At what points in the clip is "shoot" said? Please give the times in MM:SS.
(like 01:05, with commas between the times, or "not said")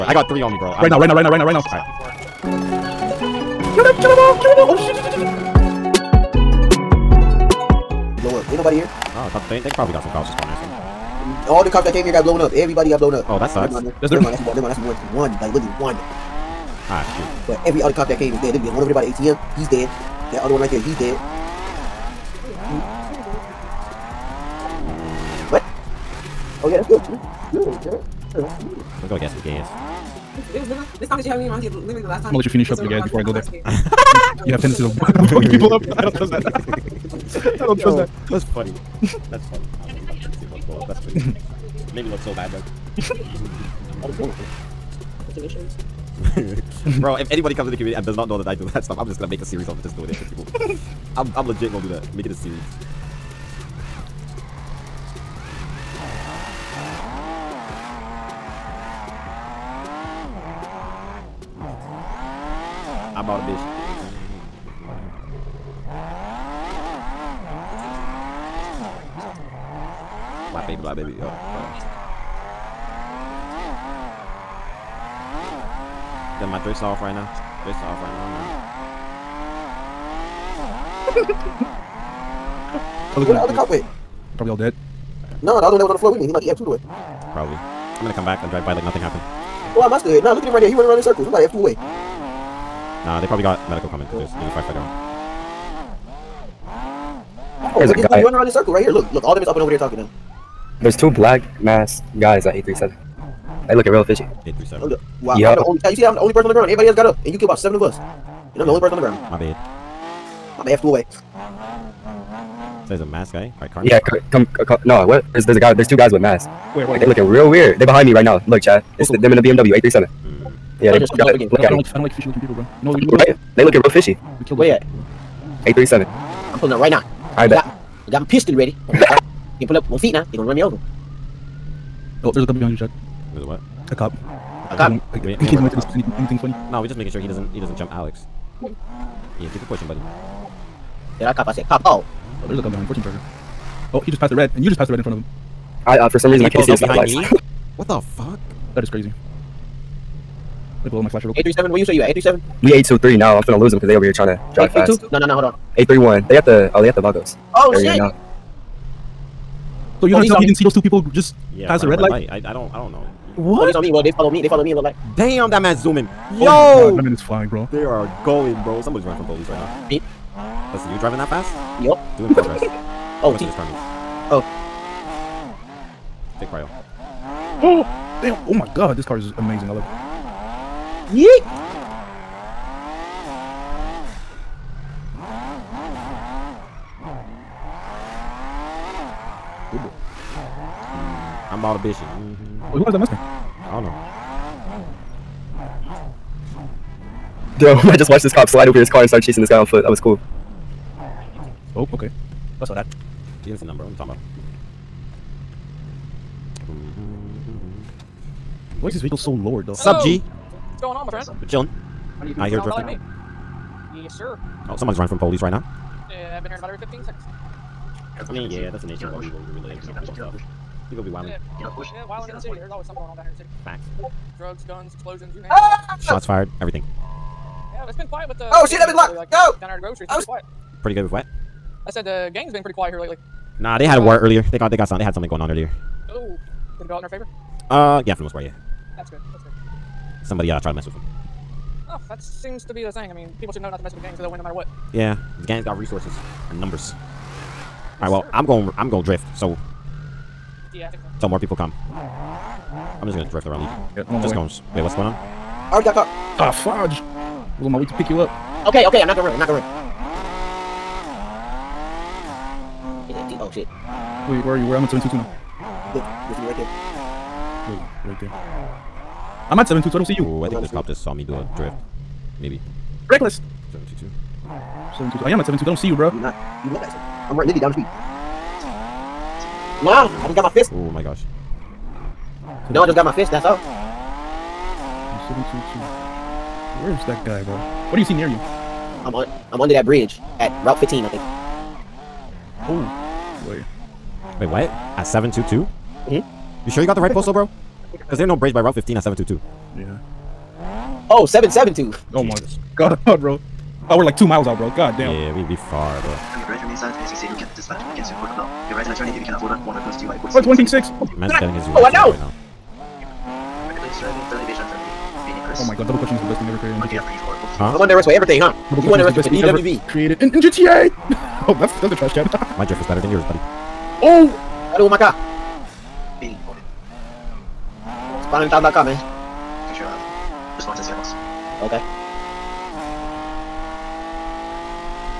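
00:17.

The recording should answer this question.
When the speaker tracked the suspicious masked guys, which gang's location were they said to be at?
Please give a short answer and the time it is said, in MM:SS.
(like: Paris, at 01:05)
Vagos, at 02:37.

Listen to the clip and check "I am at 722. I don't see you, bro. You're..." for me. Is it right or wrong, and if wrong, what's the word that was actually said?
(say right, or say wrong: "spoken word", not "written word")
right.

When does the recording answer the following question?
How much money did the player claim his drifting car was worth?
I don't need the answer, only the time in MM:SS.
05:28.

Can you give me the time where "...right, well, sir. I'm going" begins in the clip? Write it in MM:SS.
04:08.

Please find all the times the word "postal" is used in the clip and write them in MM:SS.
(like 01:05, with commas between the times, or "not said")
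04:57.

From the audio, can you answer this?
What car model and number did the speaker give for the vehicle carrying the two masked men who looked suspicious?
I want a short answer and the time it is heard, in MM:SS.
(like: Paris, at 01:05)
BMW 837, at 01:59.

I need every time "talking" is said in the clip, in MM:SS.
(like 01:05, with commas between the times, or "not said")
01:39, 03:23.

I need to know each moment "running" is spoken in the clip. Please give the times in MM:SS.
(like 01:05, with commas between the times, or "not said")
01:30, 01:38, 02:49, 03:34.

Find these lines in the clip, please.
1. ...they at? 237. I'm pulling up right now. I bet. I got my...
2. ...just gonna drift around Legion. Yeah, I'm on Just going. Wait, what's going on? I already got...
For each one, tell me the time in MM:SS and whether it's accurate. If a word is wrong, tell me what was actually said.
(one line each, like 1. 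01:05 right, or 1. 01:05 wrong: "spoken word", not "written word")
1. 02:04 wrong: "837", not "237"
2. 04:13 right.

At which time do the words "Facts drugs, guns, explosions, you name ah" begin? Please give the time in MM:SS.
03:43.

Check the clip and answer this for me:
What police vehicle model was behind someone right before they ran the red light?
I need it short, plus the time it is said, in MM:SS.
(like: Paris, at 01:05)
Charger, at 02:23.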